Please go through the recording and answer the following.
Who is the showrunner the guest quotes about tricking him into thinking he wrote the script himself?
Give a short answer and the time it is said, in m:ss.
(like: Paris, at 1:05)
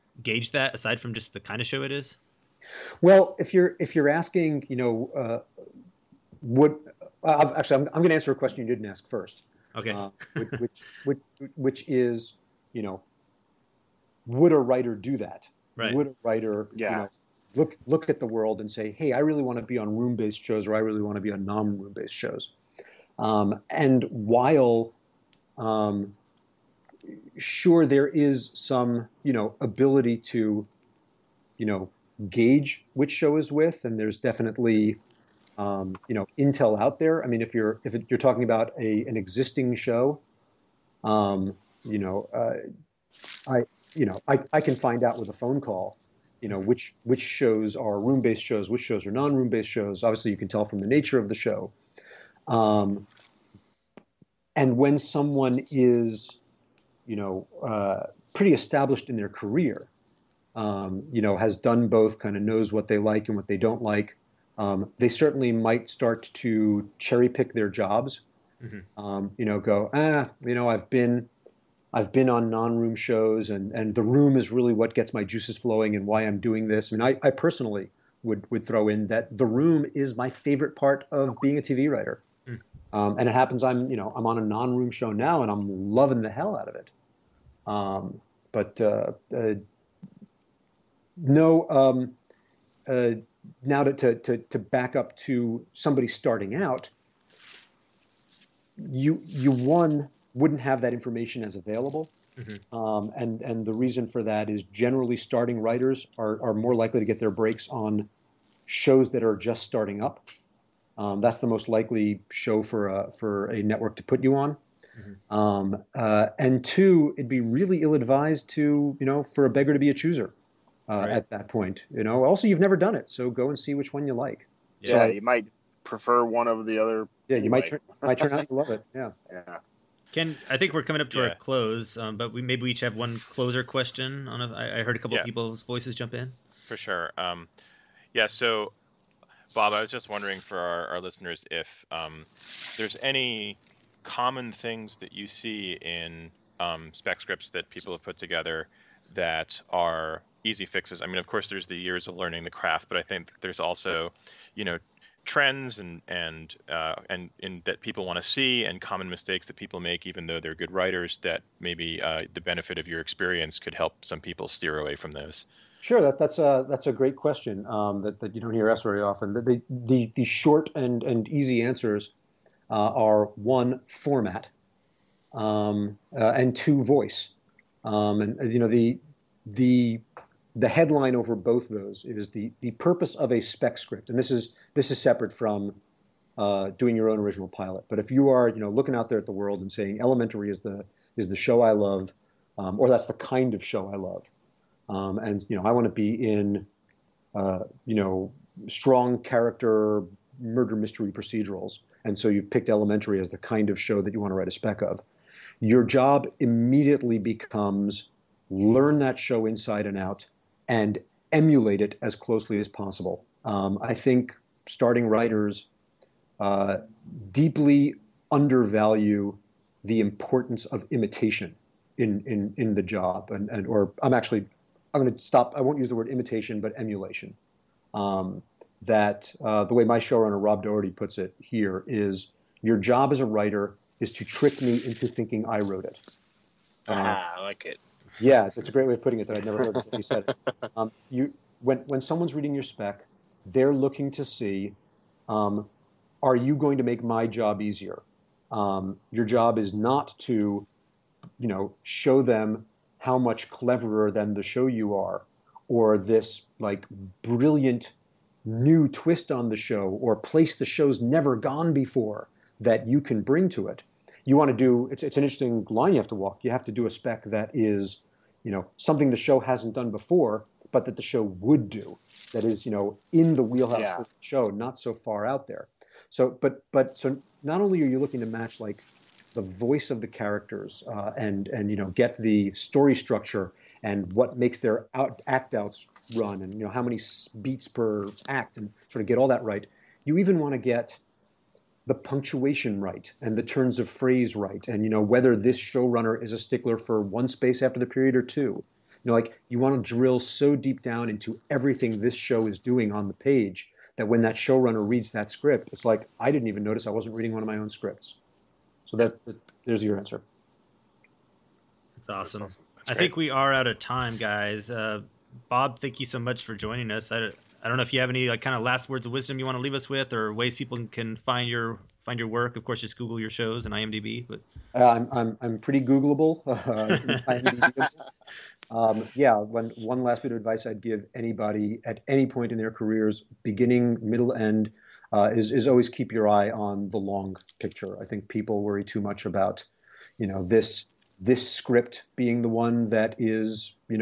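Rob Doherty, at 3:50.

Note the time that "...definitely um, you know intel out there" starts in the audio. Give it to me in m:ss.
0:34.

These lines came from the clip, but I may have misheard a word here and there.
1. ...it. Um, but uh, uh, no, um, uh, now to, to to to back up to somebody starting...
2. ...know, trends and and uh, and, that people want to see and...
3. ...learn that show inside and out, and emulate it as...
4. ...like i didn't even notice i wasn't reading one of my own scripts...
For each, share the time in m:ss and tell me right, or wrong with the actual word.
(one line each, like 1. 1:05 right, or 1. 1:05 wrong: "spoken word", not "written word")
1. 1:26 right
2. 2:34 right
3. 3:28 right
4. 5:05 right.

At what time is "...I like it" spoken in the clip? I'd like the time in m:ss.
3:57.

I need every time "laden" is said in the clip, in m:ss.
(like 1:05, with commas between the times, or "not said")
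not said.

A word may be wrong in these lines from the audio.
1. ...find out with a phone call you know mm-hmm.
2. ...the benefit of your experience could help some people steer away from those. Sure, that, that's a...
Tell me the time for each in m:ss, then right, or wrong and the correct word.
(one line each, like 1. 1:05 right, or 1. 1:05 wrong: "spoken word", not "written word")
1. 0:44 right
2. 2:42 right.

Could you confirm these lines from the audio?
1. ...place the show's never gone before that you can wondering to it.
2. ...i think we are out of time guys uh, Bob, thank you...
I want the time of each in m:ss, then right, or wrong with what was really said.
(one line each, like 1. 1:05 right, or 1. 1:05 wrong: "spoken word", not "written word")
1. 4:20 wrong: "bring", not "wondering"
2. 5:12 right.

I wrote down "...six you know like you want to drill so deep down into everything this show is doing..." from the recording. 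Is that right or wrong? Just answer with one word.
wrong.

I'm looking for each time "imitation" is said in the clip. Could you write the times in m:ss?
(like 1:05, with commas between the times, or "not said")
3:40, 3:46.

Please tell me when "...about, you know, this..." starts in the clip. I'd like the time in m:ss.
5:39.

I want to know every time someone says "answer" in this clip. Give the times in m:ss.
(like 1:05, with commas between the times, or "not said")
0:08, 2:51, 5:09.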